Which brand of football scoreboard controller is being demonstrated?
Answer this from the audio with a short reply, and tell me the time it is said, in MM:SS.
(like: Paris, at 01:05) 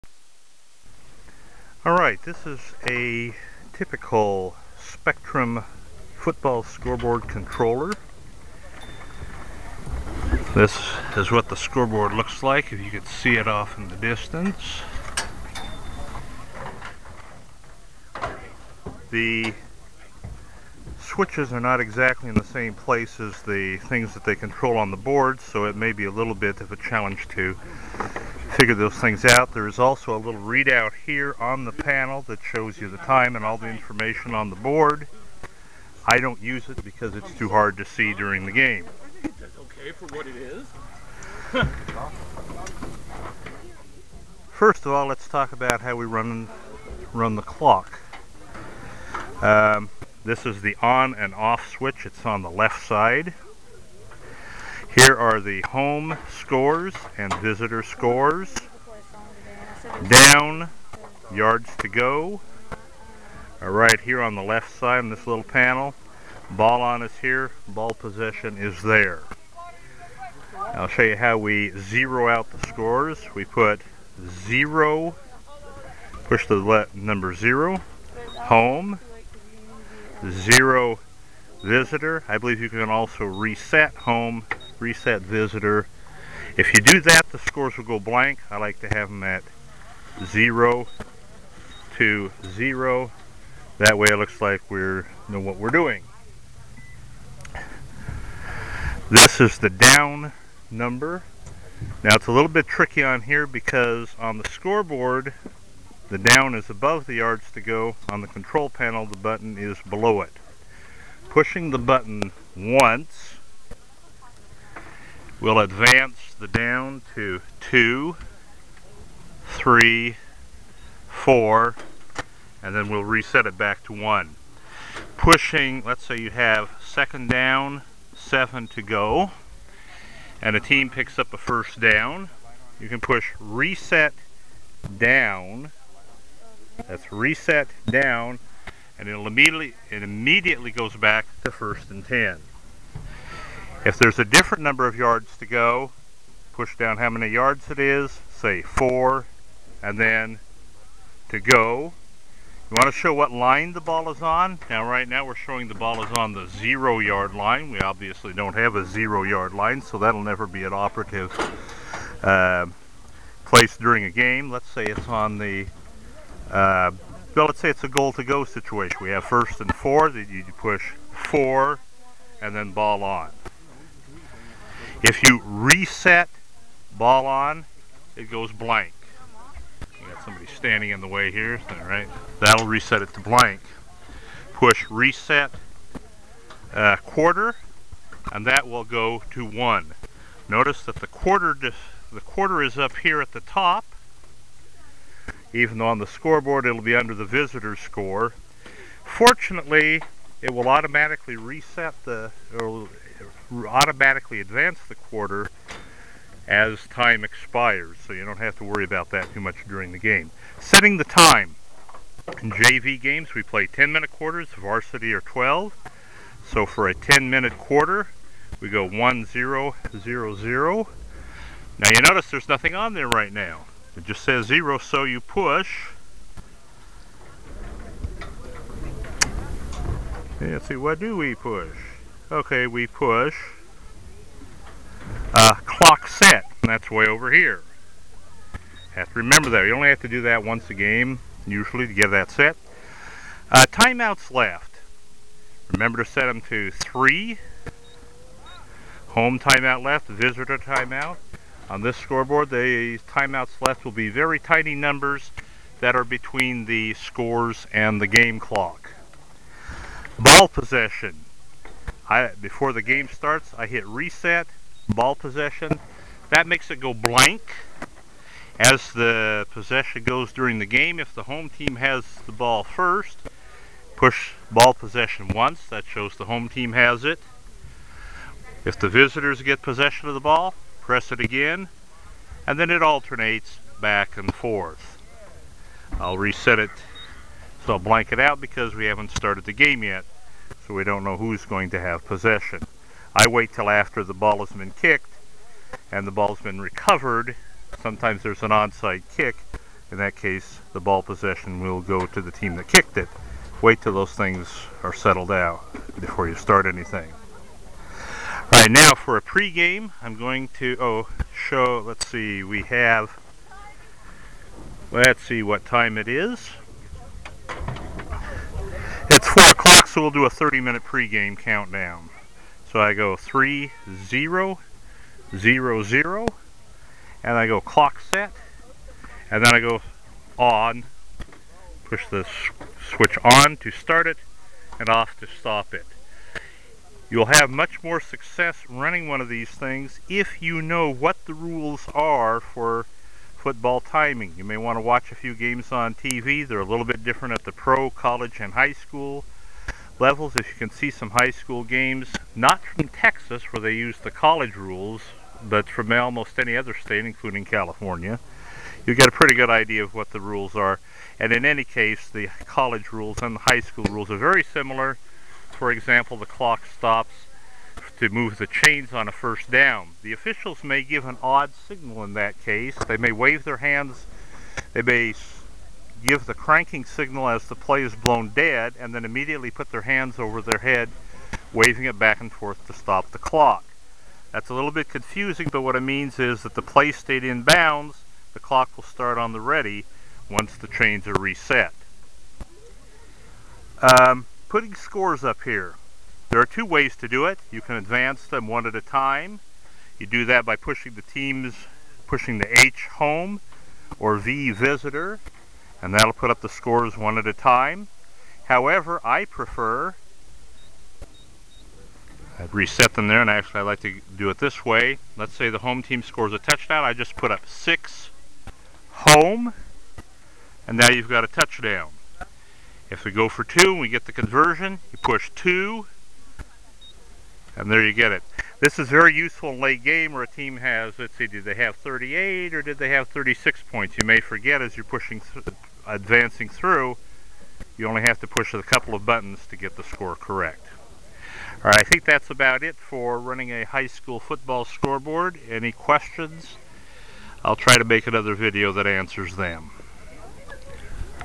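Spectrum, at 00:04.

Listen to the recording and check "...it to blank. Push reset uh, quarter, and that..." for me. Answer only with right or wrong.
right.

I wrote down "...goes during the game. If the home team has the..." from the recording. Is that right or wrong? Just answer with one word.
right.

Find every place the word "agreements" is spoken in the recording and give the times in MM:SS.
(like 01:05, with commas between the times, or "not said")
not said.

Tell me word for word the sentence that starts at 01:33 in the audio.
That way it looks like we know what we're doing.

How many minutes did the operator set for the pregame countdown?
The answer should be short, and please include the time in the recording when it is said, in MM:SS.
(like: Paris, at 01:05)
30, at 05:20.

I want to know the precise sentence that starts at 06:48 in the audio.
However, I prefer, i have reset them there, and actually I like to do it this way.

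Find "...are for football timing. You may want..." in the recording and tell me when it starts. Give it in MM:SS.
05:41.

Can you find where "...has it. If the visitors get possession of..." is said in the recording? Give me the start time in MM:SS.
04:36.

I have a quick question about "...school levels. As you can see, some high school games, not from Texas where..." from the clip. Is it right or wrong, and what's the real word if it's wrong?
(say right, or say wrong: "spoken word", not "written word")
right.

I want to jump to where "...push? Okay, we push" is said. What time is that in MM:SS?
03:51.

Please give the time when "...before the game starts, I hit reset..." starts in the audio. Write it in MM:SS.
04:22.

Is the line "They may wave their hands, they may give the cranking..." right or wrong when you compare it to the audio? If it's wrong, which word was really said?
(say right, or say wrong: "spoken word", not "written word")
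right.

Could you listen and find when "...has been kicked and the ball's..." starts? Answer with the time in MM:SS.
04:54.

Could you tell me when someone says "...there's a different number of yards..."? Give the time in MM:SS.
02:23.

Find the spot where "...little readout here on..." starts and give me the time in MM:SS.
00:30.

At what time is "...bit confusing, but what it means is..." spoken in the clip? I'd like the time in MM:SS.
06:24.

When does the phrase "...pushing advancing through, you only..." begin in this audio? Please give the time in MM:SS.
07:14.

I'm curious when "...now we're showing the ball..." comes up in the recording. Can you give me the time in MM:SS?
02:35.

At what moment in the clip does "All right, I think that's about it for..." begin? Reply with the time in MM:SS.
07:21.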